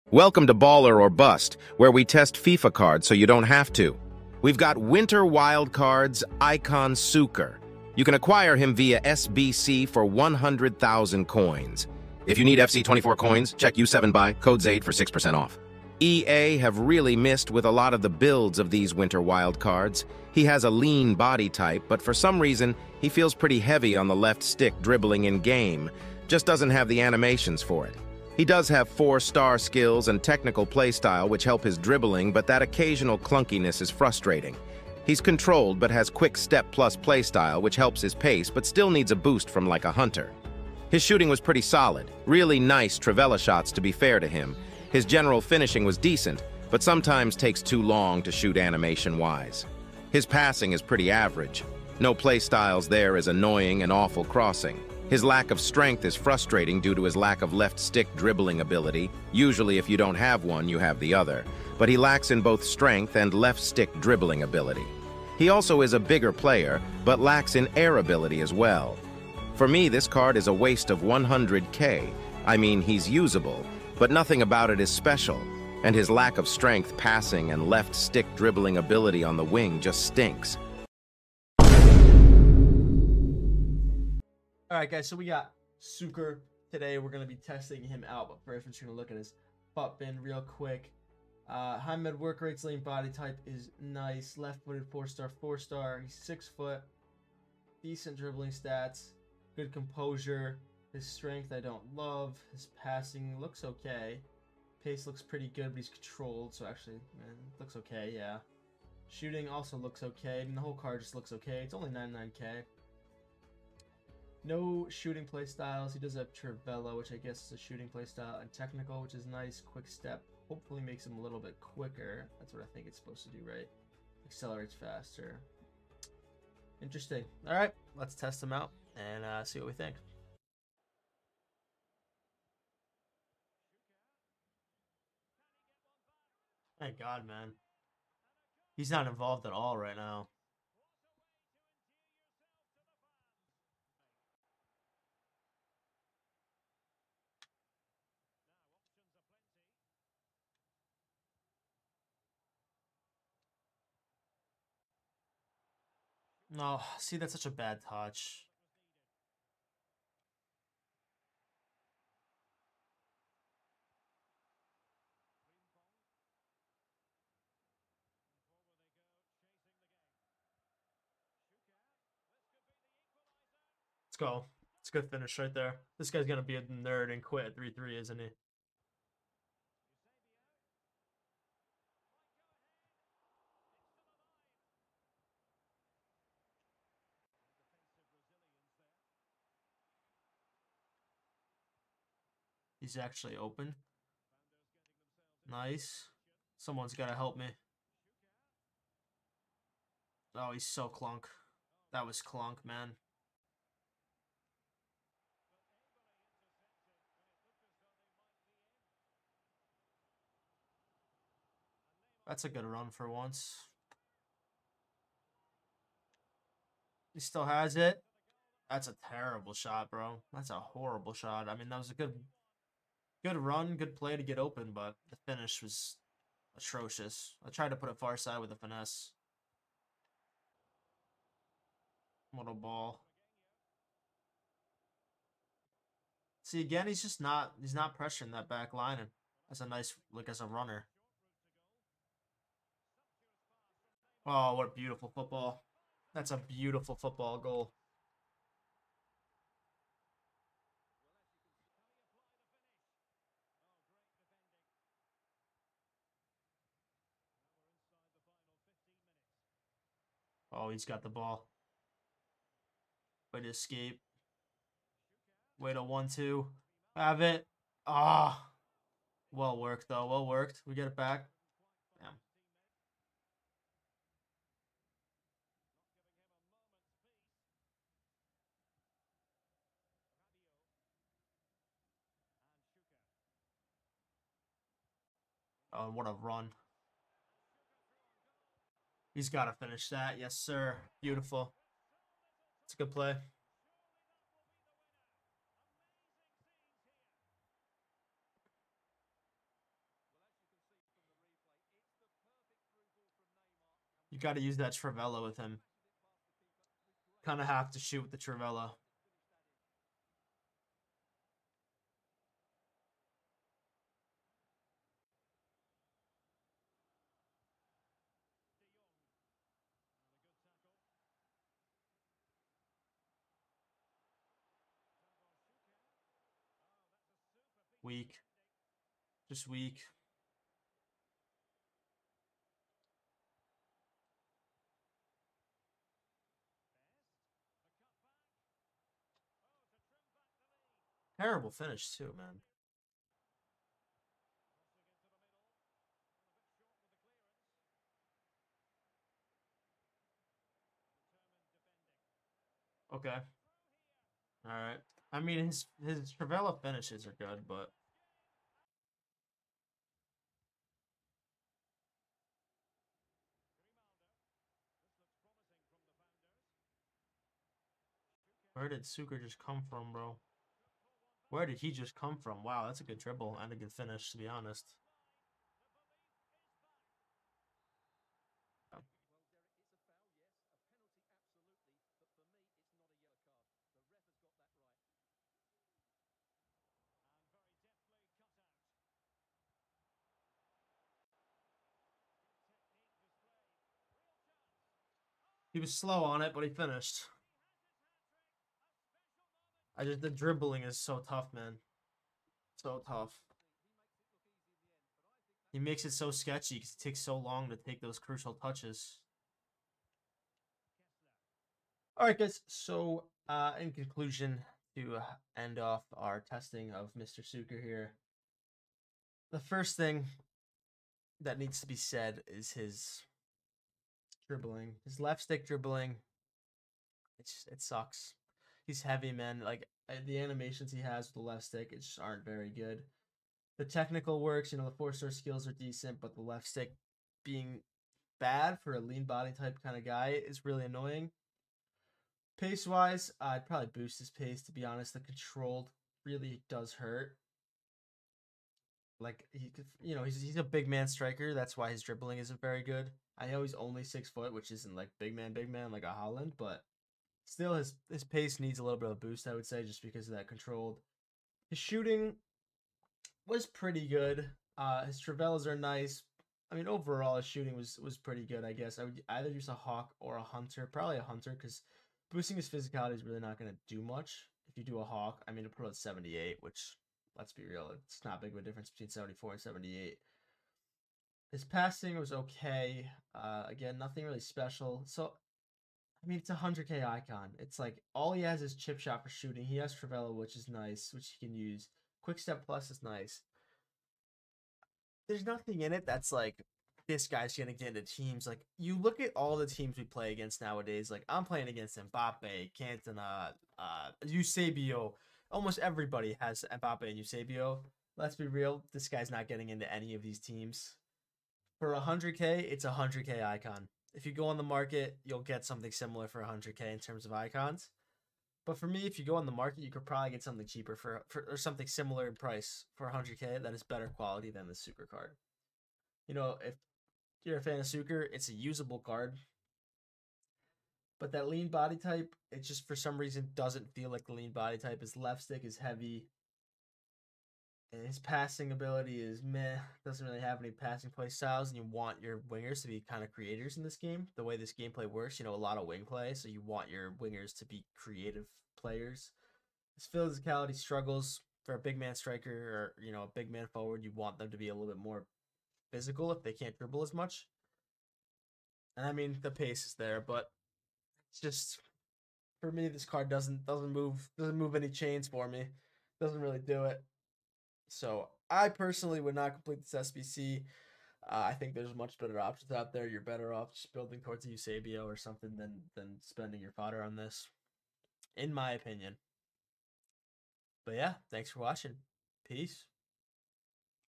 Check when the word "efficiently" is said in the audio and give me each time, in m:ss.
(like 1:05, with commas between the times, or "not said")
not said.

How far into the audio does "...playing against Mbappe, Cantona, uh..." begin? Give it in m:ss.
8:21.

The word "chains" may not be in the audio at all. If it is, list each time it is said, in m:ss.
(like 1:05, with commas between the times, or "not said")
9:24.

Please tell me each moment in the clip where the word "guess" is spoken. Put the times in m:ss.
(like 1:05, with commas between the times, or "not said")
1:57, 7:48.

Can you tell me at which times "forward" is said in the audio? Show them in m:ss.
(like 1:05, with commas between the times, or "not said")
9:13.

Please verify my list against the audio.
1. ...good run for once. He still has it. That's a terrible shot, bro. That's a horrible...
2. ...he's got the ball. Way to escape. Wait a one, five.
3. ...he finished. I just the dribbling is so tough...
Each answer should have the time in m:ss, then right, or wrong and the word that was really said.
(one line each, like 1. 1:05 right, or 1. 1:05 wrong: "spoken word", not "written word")
1. 3:32 right
2. 4:20 wrong: "two", not "five"
3. 6:36 right.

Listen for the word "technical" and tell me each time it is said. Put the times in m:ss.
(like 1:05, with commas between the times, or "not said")
0:30, 1:58, 7:13.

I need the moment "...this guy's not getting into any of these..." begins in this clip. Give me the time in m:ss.
8:28.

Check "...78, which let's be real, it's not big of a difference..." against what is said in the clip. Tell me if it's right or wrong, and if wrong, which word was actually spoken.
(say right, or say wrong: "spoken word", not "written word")
right.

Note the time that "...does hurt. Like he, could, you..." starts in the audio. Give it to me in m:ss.
7:26.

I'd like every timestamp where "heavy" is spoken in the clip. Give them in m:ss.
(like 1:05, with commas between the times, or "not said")
0:23, 7:08, 8:55.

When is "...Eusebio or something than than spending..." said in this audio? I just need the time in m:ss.
9:34.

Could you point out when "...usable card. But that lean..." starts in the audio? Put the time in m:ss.
8:48.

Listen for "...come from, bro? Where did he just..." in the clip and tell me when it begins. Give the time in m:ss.
6:09.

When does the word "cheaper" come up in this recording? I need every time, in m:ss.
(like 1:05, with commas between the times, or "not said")
8:40.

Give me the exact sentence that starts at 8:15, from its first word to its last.
There's nothing in it that's like this guy's gonna get into teams.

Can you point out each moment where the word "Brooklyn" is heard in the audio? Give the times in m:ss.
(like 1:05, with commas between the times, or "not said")
not said.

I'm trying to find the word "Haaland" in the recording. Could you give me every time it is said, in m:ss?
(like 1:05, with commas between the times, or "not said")
7:35.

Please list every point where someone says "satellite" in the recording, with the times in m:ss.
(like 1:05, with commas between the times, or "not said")
not said.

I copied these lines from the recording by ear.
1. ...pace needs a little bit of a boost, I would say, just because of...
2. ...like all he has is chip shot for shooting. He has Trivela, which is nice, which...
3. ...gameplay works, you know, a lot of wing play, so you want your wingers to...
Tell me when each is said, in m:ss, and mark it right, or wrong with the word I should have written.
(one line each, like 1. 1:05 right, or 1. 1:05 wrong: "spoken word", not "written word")
1. 7:38 right
2. 8:07 right
3. 9:04 right.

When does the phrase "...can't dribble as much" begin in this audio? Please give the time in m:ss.
9:16.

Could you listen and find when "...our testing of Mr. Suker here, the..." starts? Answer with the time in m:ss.
6:55.